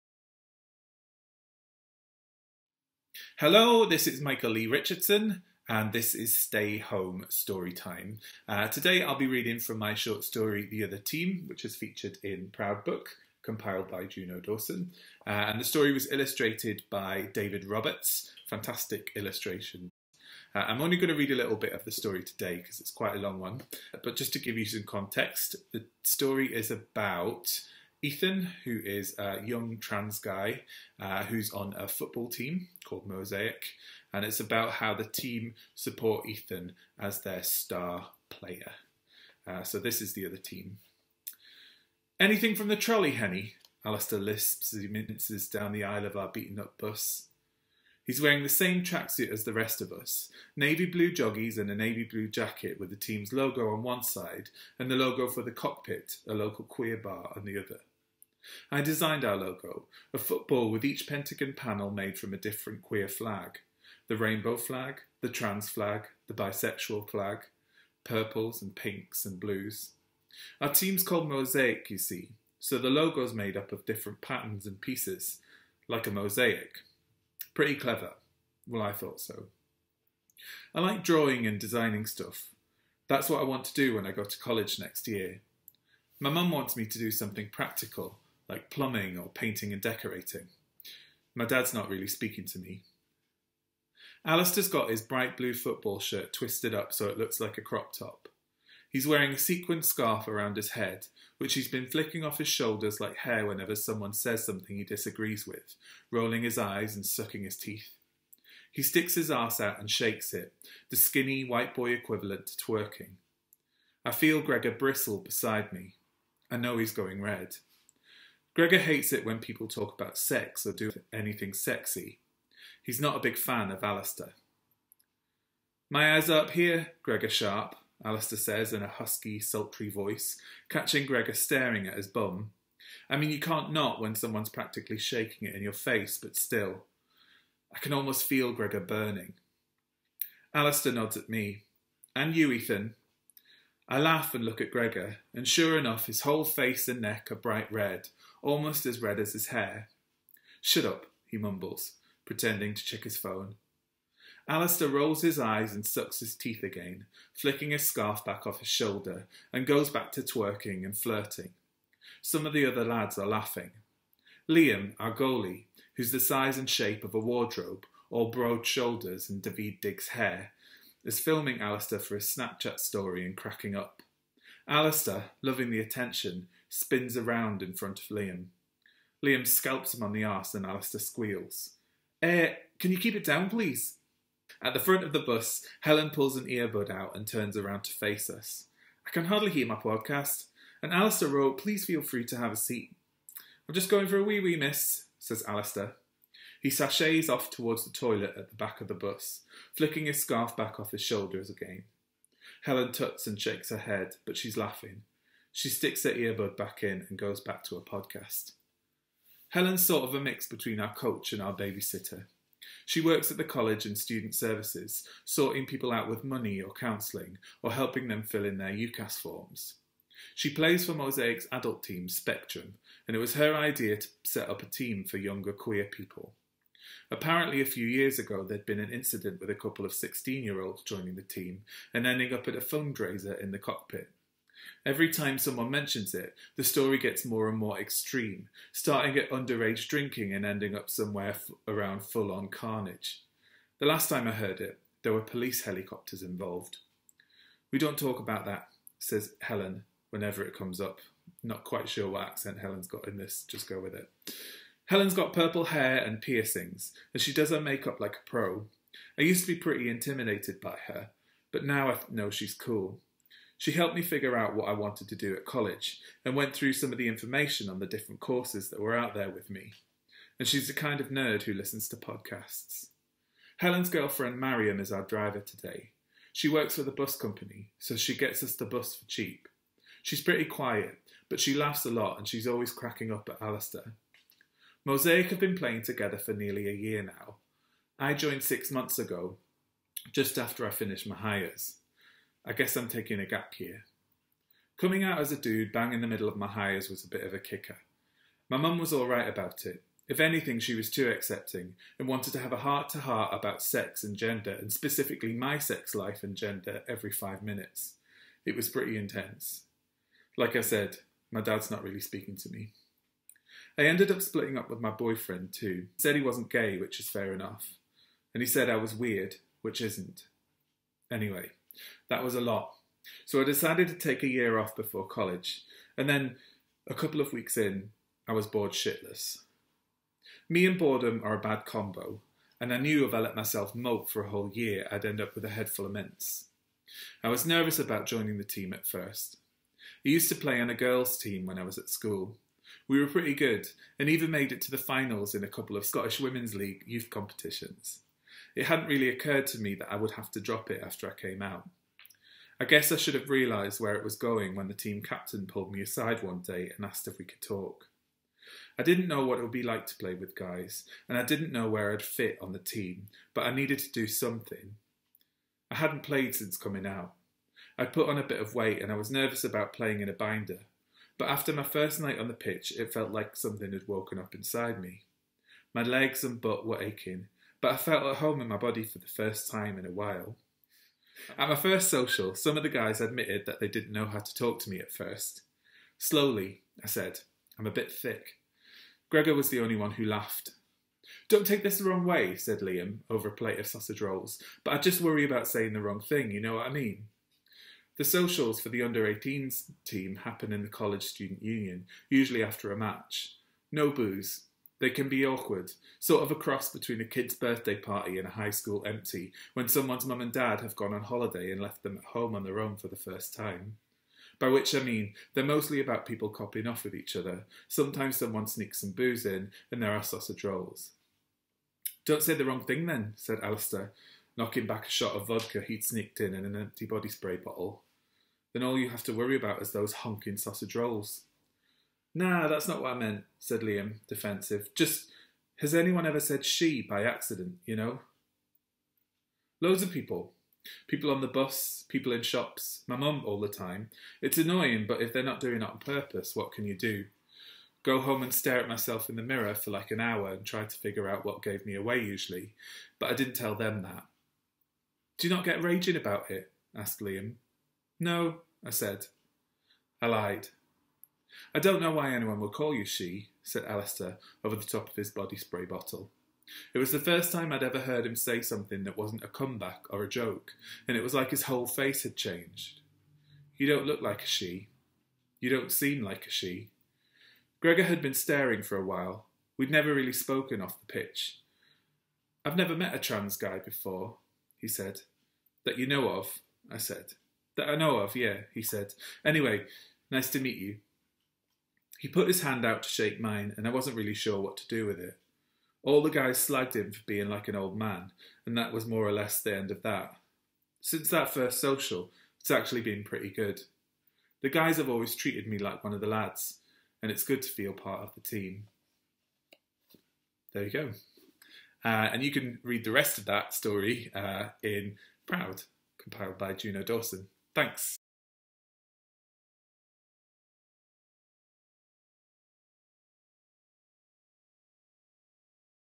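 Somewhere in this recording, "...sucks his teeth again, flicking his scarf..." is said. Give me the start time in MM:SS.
02:35.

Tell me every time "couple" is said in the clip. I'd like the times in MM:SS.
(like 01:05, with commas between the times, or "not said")
03:49, 05:26, 05:45.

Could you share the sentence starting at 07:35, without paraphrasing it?
Do you not get raging about it?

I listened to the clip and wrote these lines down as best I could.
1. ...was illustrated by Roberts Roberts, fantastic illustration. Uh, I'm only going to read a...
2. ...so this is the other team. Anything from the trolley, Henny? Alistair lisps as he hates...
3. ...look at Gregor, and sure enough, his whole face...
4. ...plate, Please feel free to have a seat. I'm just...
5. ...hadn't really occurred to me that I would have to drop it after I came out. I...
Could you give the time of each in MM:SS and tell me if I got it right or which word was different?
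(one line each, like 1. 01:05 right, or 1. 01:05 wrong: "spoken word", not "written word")
1. 00:15 wrong: "David", not "Roberts"
2. 00:39 wrong: "minces", not "hates"
3. 02:24 right
4. 03:11 wrong: "wrote", not "plate"
5. 05:48 right.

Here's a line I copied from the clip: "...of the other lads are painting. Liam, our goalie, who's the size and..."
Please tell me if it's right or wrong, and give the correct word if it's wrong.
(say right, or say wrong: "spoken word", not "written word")
wrong: "laughing", not "painting".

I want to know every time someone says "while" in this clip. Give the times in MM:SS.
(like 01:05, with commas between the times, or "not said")
06:19, 07:58.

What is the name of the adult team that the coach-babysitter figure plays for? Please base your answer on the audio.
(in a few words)
Spectrum.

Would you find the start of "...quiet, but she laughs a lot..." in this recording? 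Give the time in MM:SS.
04:40.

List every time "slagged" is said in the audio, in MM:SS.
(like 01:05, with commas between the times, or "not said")
08:16.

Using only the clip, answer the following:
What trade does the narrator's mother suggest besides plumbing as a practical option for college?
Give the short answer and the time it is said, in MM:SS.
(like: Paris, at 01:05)
painting and decorating, at 01:29.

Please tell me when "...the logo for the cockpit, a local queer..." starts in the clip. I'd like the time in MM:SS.
00:54.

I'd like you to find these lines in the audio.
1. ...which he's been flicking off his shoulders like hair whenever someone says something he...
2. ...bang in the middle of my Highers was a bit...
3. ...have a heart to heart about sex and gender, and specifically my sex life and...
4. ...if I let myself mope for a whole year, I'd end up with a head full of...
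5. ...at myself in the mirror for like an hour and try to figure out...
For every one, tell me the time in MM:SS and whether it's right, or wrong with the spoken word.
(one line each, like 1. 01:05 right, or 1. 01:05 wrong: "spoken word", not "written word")
1. 01:41 right
2. 04:55 right
3. 05:02 right
4. 05:33 right
5. 07:28 right.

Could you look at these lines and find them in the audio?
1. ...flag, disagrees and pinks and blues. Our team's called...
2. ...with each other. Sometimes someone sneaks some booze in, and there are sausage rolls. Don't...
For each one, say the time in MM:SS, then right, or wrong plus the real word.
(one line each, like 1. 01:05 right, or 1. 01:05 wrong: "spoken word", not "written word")
1. 01:07 wrong: "purples", not "disagrees"
2. 06:56 right.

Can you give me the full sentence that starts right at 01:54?
I feel Gregor bristle beside me.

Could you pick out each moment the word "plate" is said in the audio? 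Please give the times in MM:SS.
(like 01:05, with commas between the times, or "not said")
06:33.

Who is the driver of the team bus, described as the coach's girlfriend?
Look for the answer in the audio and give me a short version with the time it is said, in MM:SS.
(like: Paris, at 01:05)
Mariam, at 04:34.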